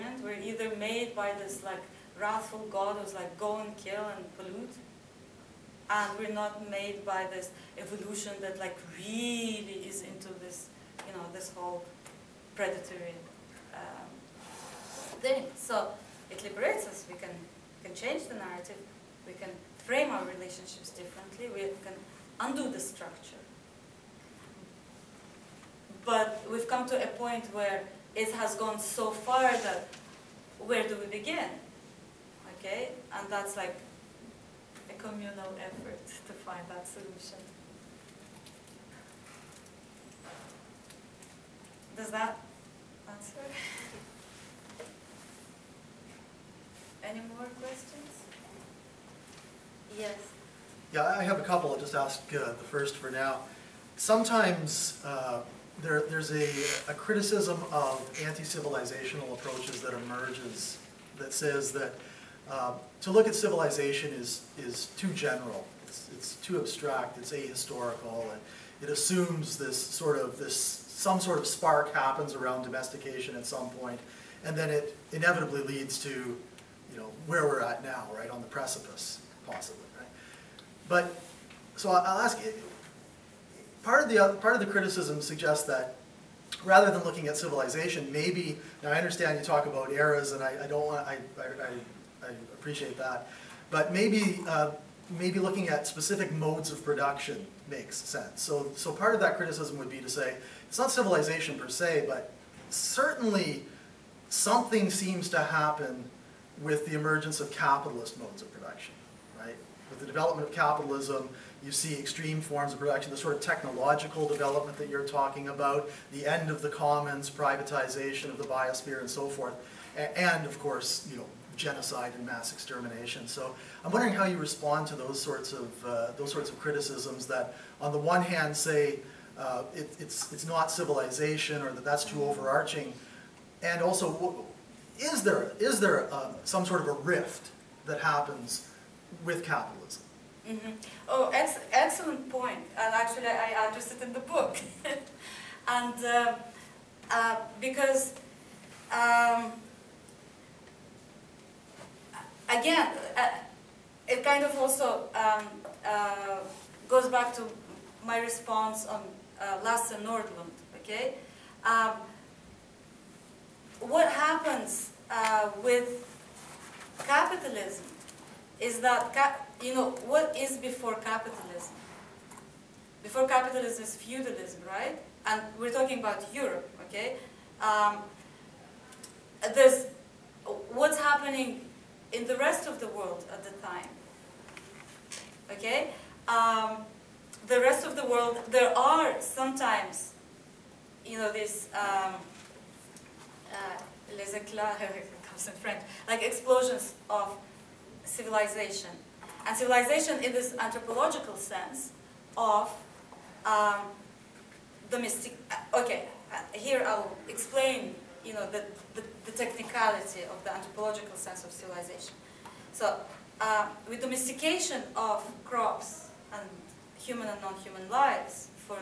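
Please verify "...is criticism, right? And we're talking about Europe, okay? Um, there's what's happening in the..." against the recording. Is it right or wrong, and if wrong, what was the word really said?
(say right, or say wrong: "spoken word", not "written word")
wrong: "feudalism", not "criticism".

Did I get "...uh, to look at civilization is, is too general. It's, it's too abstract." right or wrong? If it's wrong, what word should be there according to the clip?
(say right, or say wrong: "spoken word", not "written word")
right.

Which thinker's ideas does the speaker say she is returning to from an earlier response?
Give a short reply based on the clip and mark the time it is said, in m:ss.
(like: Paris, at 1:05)
Lasse Nordlund, at 2:39.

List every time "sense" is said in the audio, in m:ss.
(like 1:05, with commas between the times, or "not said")
1:37, 3:21, 3:31.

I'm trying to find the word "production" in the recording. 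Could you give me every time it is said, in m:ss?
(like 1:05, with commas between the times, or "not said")
1:36, 1:48, 1:52.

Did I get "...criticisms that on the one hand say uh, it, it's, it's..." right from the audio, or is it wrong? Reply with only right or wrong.
right.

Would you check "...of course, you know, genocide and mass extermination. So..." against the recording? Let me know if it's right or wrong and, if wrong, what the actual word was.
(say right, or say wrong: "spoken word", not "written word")
right.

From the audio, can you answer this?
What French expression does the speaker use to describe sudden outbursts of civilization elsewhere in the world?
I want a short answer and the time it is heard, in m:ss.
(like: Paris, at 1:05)
les éclats, at 3:14.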